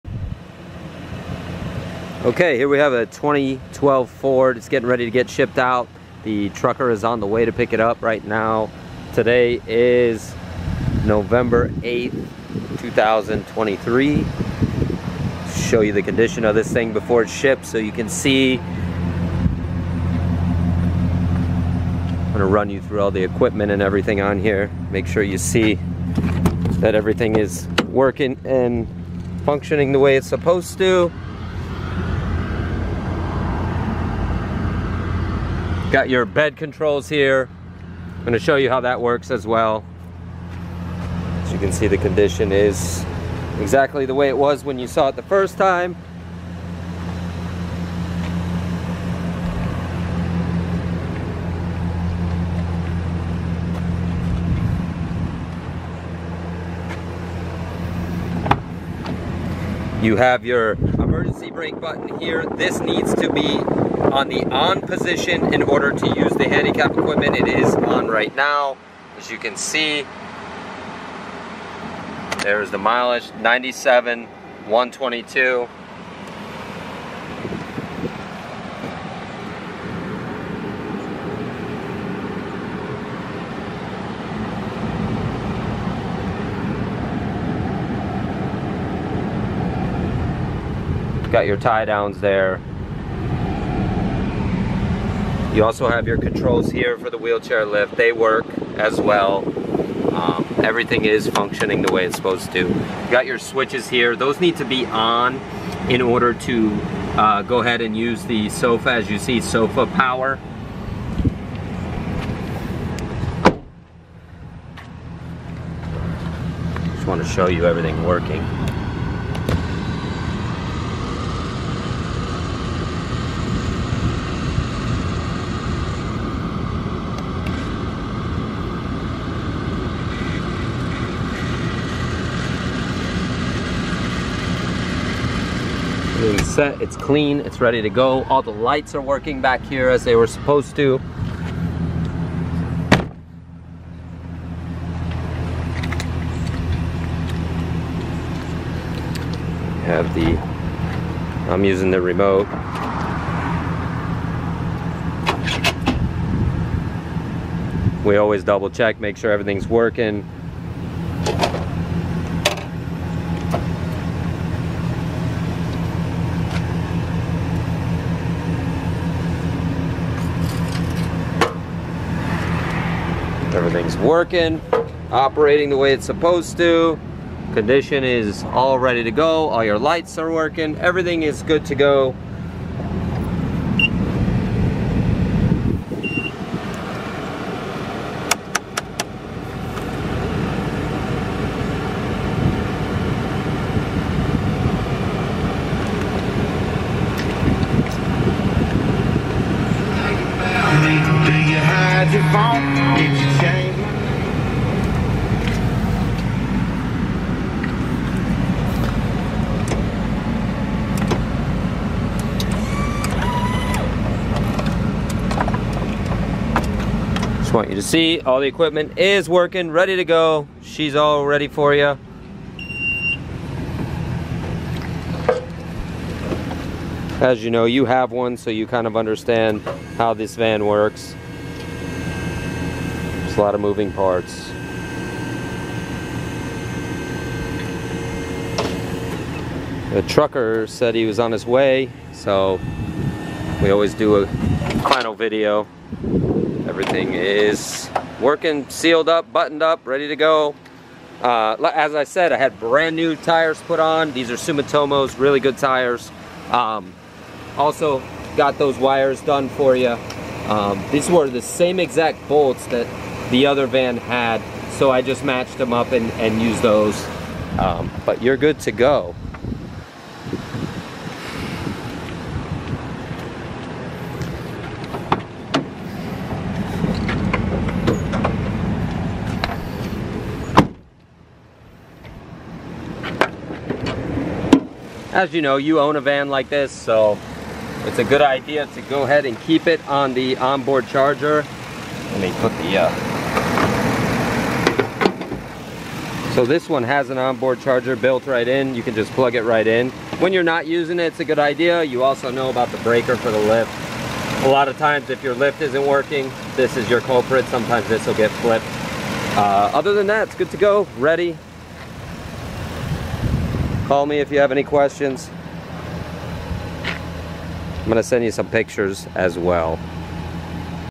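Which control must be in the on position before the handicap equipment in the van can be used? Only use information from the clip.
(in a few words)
emergency brake button.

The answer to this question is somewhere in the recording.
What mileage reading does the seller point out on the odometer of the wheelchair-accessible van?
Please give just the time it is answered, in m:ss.
1:13.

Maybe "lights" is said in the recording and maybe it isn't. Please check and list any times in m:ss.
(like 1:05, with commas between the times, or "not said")
2:18, 2:59.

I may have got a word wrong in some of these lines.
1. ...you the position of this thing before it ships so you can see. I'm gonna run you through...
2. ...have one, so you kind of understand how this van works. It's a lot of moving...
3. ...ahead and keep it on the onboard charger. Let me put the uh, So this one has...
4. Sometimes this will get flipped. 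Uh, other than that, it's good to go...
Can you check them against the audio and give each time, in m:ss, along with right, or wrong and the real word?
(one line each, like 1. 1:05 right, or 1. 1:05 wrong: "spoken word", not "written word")
1. 0:15 wrong: "condition", not "position"
2. 3:47 right
3. 4:49 right
4. 5:07 right.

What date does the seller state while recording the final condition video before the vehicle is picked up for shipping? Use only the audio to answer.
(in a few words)
November 8th, 2023.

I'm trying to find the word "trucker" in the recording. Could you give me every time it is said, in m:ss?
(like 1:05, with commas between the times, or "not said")
0:06, 4:00.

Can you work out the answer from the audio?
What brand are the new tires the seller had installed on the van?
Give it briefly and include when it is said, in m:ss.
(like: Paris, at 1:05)
Sumitomo, at 4:14.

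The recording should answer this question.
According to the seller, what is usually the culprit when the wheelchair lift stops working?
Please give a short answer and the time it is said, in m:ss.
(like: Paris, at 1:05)
the breaker, at 5:02.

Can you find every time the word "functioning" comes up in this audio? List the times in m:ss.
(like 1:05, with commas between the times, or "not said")
0:29, 1:41.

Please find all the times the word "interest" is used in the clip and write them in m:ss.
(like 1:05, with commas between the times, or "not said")
not said.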